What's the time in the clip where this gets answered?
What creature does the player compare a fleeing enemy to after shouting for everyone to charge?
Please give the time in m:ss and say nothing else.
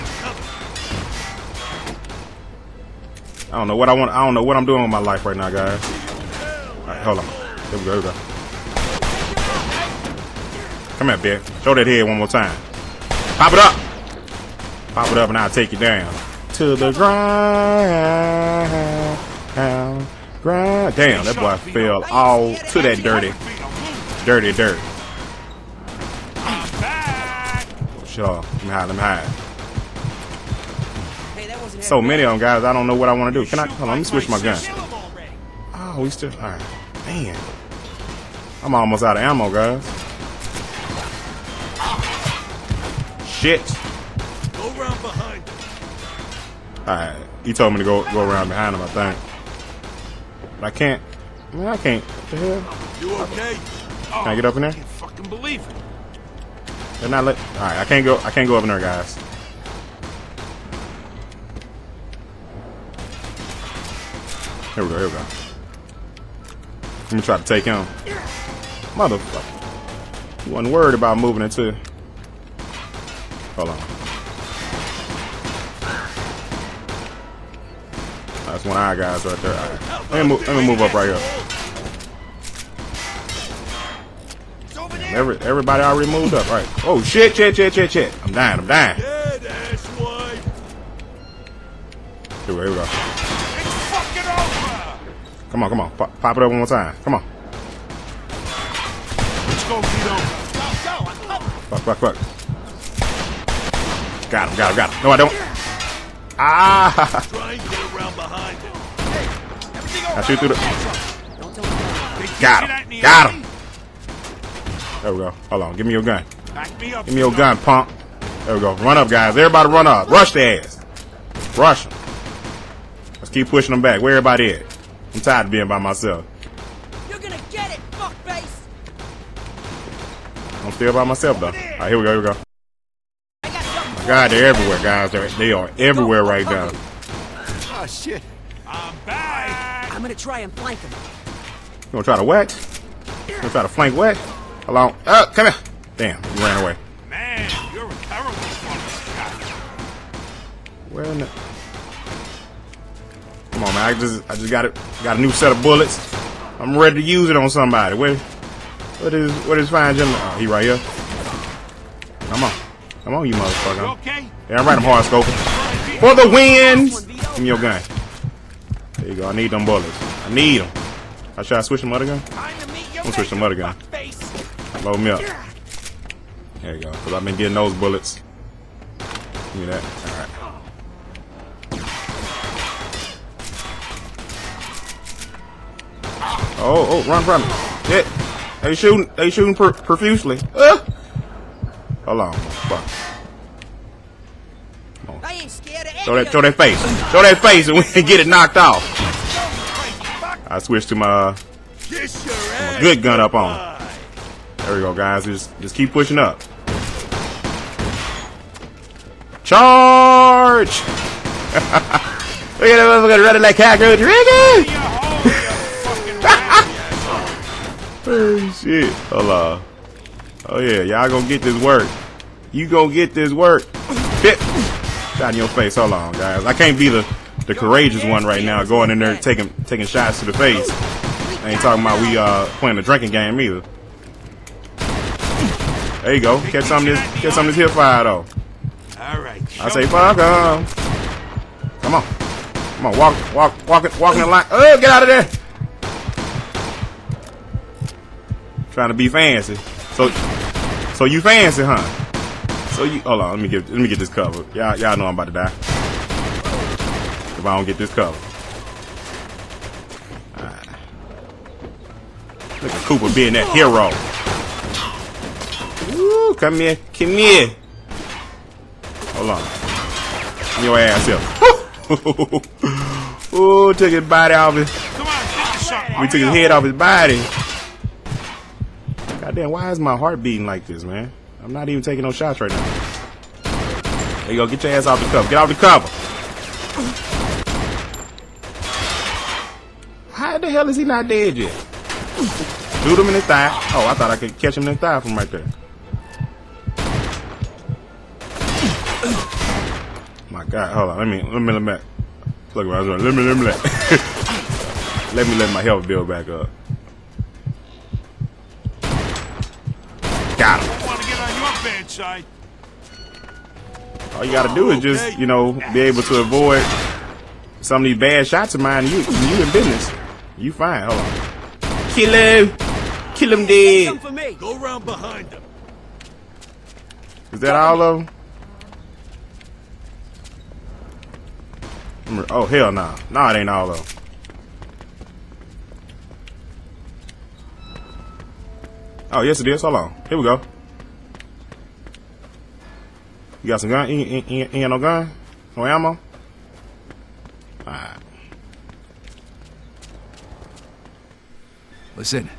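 3:33.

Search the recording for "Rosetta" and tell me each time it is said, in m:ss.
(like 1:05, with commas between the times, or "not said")
not said.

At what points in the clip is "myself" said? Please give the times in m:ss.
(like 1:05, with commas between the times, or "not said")
2:05, 2:11.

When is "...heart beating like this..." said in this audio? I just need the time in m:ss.
4:39.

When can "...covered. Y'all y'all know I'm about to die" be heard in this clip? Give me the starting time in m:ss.
4:14.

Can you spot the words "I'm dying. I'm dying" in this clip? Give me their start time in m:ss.
1:28.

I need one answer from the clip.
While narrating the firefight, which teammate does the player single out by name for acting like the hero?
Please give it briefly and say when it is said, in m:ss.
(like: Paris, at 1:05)
Cooper, at 4:22.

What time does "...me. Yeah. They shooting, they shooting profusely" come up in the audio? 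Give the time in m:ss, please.
3:07.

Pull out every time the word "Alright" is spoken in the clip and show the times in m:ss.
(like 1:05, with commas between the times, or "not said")
0:06, 3:00, 3:58, 5:47.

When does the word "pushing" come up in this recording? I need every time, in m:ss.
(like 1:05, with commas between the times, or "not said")
2:03, 3:25.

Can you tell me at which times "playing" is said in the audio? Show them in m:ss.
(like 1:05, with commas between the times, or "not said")
3:52.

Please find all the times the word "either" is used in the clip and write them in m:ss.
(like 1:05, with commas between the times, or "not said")
3:53.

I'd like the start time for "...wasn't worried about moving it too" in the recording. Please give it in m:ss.
1:10.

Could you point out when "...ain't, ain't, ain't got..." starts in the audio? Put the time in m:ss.
5:44.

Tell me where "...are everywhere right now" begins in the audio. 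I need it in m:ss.
2:15.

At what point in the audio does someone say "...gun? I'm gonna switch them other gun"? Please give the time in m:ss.
2:52.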